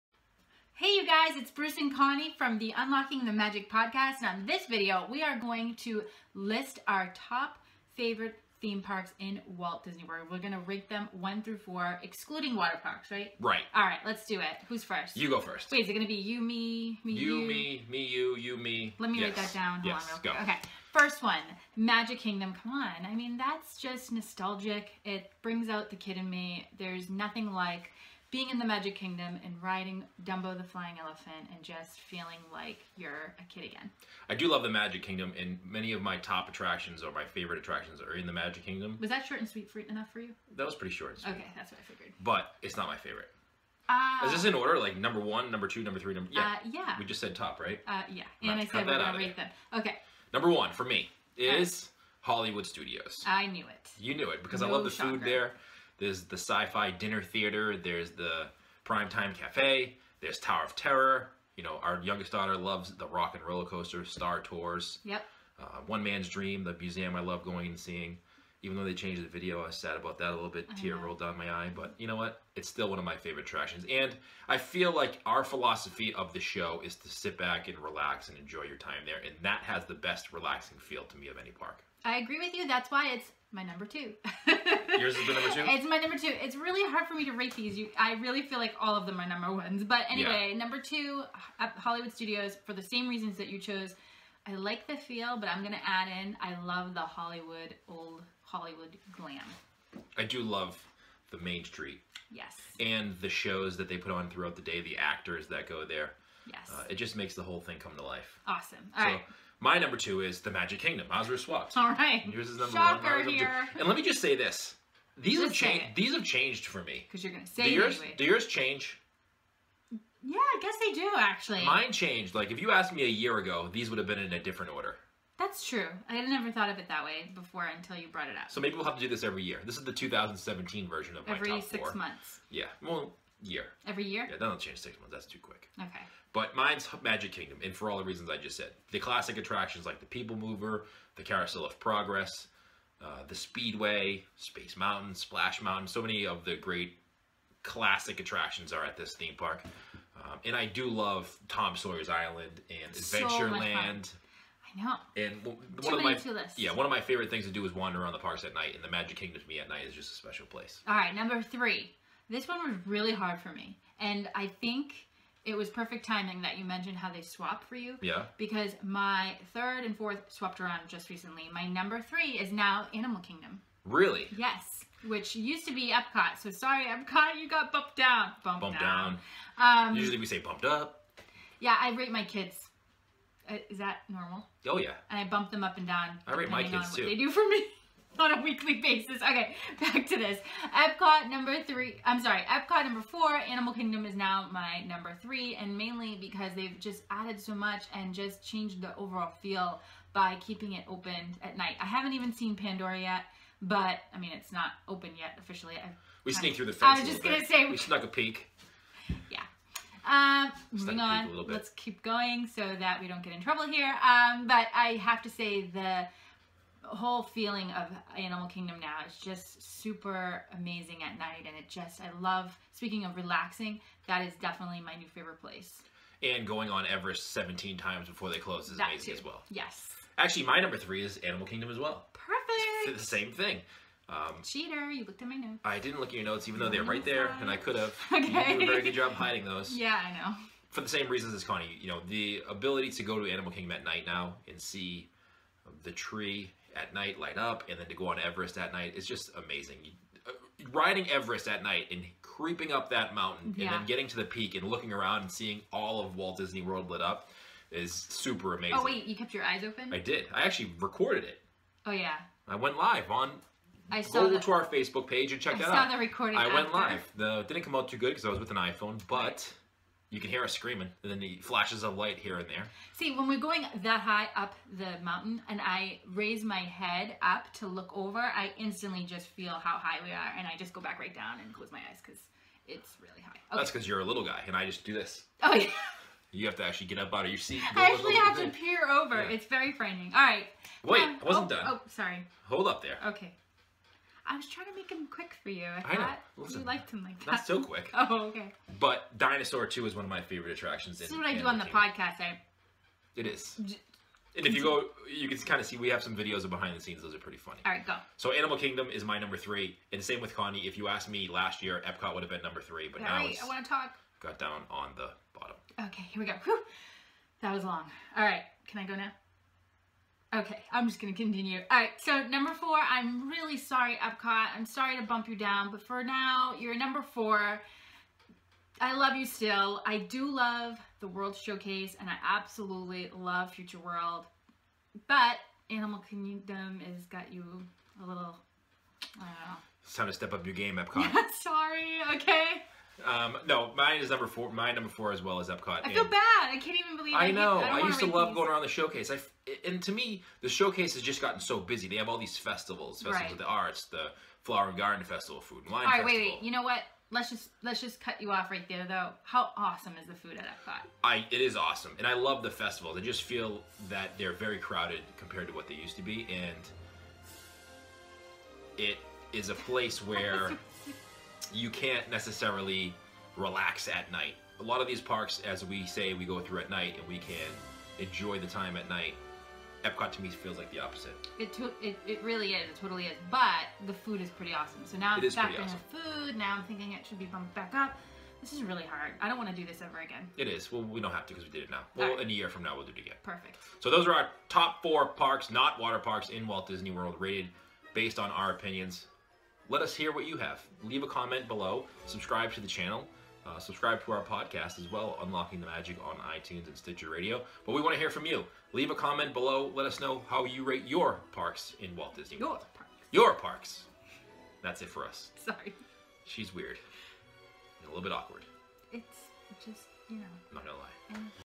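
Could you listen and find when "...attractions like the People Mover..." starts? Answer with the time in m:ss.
2:19.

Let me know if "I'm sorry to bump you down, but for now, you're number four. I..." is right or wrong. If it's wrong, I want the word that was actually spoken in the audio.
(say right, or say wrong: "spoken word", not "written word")
right.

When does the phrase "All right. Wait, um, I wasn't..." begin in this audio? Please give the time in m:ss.
4:50.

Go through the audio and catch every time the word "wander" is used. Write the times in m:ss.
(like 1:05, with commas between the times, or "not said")
2:37.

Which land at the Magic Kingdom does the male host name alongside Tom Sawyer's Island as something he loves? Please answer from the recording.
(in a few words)
Adventureland.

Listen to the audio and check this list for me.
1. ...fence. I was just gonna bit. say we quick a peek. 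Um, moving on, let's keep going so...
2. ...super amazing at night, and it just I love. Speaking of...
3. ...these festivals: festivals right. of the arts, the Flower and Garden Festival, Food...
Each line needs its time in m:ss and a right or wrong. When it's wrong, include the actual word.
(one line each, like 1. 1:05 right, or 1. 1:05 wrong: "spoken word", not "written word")
1. 3:26 wrong: "snuck", not "quick"
2. 3:39 right
3. 5:52 right.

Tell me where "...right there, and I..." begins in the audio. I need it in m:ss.
3:56.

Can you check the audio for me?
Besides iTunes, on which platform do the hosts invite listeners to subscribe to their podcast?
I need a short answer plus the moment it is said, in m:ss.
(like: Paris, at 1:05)
Stitcher Radio, at 6:46.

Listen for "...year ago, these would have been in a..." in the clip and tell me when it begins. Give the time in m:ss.
2:03.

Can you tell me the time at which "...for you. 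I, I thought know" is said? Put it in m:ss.
4:55.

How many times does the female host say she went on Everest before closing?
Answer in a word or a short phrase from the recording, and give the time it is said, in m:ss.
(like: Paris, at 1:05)
17, at 3:47.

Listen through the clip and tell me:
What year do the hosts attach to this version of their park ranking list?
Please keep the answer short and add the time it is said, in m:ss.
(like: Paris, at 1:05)
2017, at 2:09.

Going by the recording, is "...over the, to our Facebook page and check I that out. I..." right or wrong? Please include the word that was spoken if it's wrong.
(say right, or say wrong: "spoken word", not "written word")
right.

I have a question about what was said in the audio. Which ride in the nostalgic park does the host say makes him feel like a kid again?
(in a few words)
Dumbo the Flying Elephant.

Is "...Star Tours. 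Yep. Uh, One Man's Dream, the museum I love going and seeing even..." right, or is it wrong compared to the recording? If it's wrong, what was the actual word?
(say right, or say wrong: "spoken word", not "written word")
right.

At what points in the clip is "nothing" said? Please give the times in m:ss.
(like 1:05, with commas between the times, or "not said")
0:27.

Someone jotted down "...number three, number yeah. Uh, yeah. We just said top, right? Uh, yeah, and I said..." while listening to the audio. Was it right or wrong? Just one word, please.
right.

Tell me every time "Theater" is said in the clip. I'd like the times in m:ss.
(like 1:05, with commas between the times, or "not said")
0:57.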